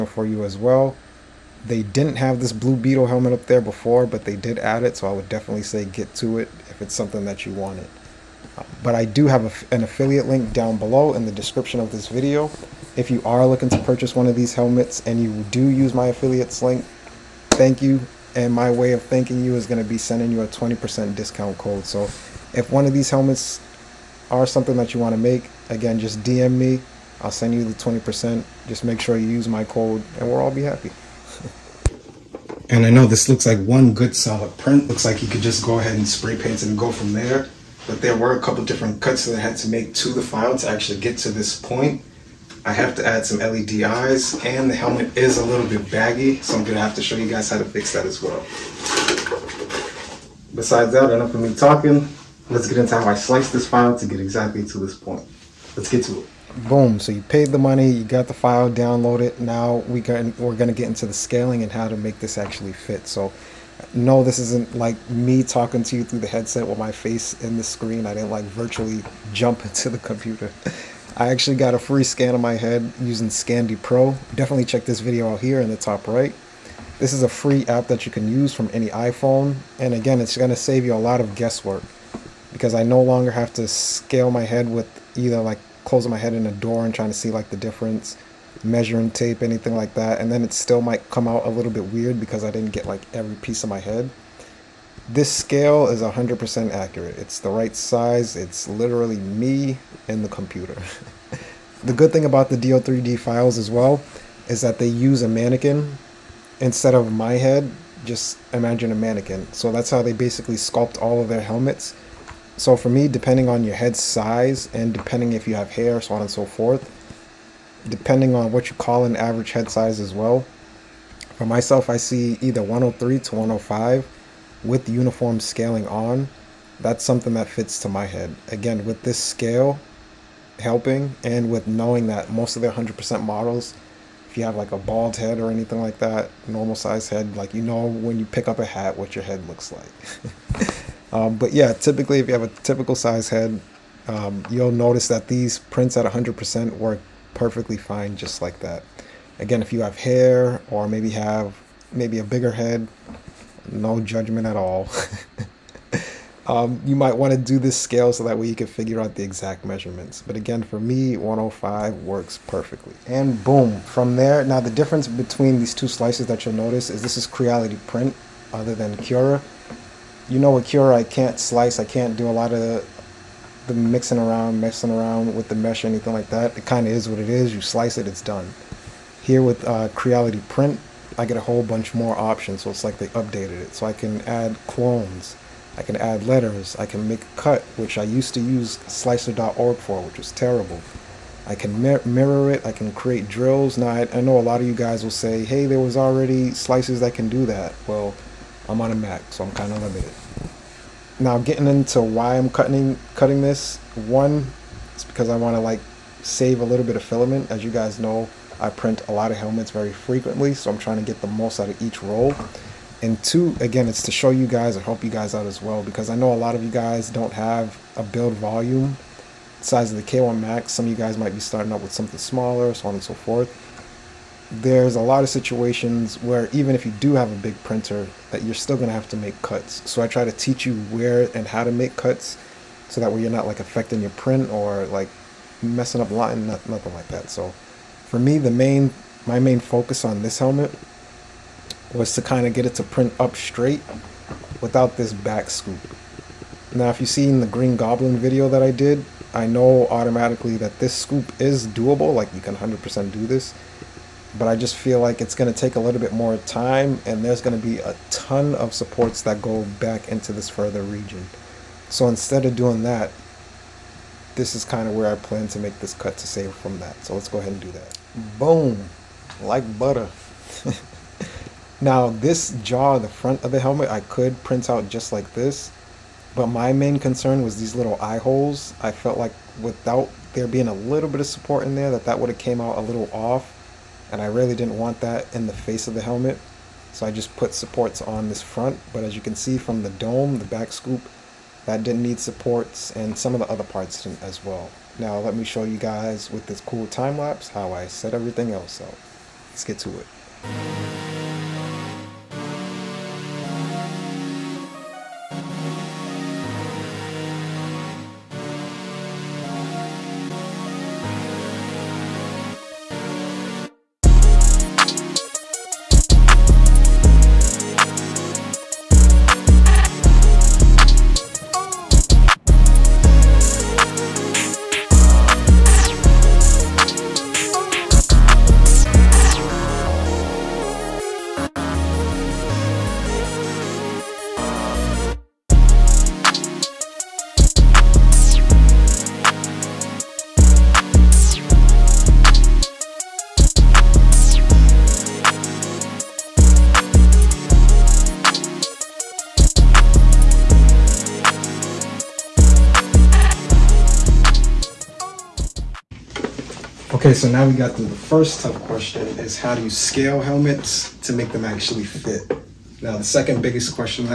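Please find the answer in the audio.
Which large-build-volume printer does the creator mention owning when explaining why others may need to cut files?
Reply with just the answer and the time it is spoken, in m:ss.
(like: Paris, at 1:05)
K1 Max, at 3:40.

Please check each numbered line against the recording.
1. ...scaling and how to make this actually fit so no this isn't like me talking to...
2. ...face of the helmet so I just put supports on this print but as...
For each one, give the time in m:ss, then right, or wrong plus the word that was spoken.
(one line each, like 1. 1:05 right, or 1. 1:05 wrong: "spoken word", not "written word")
1. 1:01 right
2. 4:45 wrong: "front", not "print".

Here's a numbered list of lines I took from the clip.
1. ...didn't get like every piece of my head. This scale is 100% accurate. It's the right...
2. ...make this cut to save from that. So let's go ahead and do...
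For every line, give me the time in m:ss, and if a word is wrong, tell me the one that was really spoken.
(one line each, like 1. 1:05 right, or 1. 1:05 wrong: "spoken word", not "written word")
1. 1:32 right
2. 4:25 right.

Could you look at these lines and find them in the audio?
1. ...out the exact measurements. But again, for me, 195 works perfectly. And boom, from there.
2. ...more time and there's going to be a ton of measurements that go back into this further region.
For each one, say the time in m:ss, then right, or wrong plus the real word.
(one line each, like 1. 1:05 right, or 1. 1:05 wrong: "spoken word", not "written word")
1. 2:38 wrong: "105", not "195"
2. 4:16 wrong: "supports", not "measurements".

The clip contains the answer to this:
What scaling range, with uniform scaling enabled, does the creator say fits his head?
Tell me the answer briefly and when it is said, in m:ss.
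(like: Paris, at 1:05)
103 to 105, at 2:02.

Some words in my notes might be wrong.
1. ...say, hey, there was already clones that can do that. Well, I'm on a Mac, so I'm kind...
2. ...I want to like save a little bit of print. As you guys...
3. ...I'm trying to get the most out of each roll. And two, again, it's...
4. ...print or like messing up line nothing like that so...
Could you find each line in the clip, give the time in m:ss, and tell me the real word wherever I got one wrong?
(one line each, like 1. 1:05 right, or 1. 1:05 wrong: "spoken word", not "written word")
1. 3:15 wrong: "slices", not "clones"
2. 3:25 wrong: "filament", not "print"
3. 3:30 right
4. 3:54 right.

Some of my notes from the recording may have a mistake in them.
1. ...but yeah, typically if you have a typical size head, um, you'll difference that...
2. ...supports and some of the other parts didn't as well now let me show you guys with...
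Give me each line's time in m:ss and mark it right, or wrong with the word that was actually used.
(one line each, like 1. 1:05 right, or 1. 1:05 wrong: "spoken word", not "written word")
1. 2:21 wrong: "notice", not "difference"
2. 4:52 right.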